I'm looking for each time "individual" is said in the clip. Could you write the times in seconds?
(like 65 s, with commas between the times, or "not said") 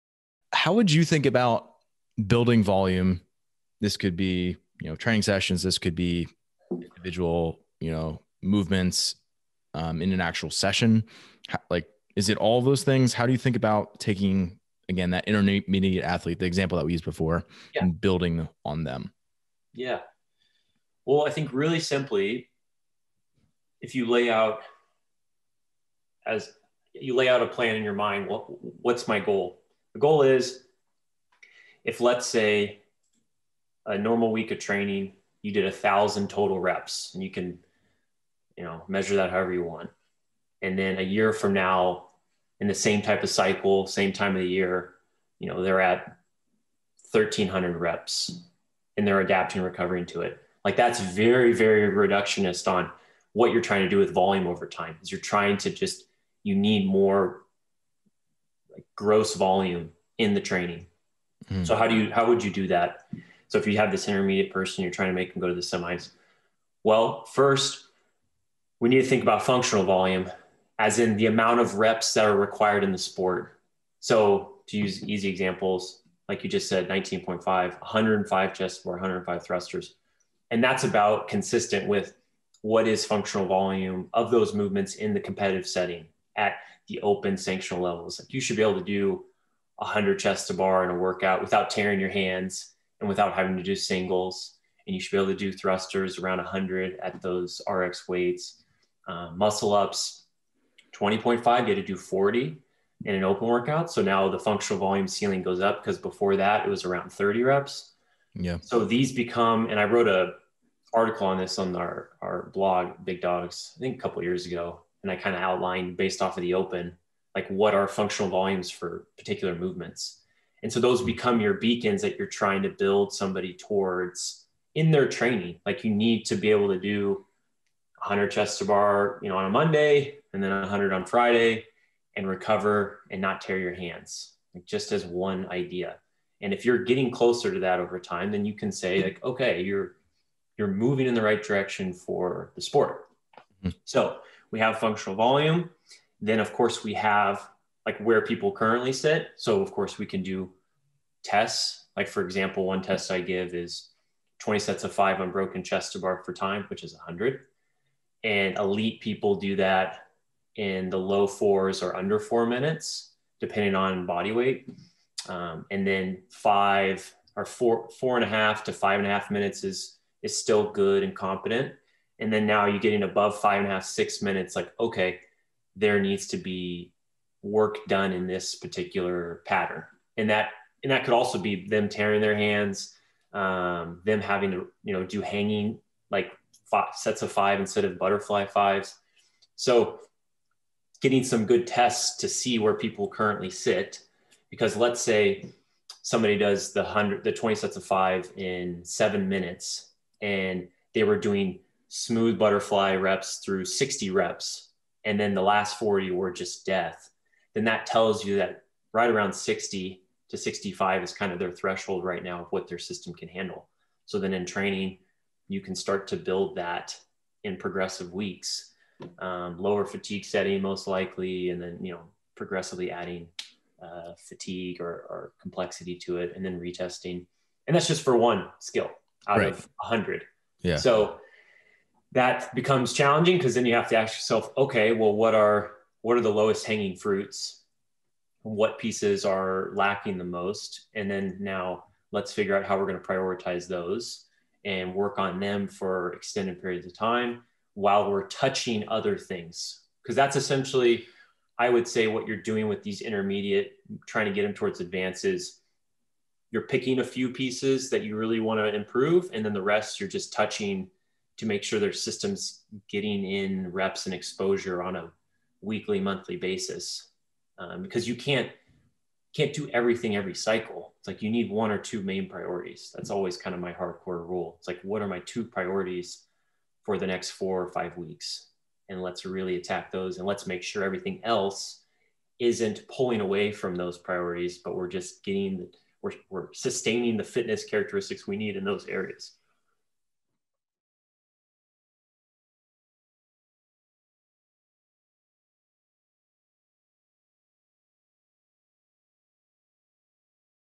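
6 s.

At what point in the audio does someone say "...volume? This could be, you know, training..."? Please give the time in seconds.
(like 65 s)
2 s.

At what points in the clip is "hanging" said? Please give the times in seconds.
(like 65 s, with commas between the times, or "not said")
185 s, 236 s.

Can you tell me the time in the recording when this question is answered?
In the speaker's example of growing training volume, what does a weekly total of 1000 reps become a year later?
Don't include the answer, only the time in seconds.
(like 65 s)
47 s.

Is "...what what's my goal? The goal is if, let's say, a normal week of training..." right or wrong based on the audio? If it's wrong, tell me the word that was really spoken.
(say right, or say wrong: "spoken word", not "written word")
right.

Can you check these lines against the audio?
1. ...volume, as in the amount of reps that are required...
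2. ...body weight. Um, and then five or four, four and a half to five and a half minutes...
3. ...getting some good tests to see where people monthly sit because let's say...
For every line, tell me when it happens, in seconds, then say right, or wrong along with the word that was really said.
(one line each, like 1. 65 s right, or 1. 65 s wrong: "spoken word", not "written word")
1. 69 s right
2. 164 s right
3. 191 s wrong: "currently", not "monthly".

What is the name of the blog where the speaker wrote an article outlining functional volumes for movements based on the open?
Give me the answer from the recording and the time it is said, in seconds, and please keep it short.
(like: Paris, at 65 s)
Big Dogs, at 113 s.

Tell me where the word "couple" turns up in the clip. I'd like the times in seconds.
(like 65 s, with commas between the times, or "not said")
114 s.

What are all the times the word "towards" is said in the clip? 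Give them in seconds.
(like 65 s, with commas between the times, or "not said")
123 s, 254 s.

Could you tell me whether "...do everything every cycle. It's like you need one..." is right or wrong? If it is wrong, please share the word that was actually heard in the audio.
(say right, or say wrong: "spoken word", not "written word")
right.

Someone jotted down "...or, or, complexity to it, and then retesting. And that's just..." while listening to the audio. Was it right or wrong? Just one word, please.
right.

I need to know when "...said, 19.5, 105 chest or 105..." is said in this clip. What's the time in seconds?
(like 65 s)
76 s.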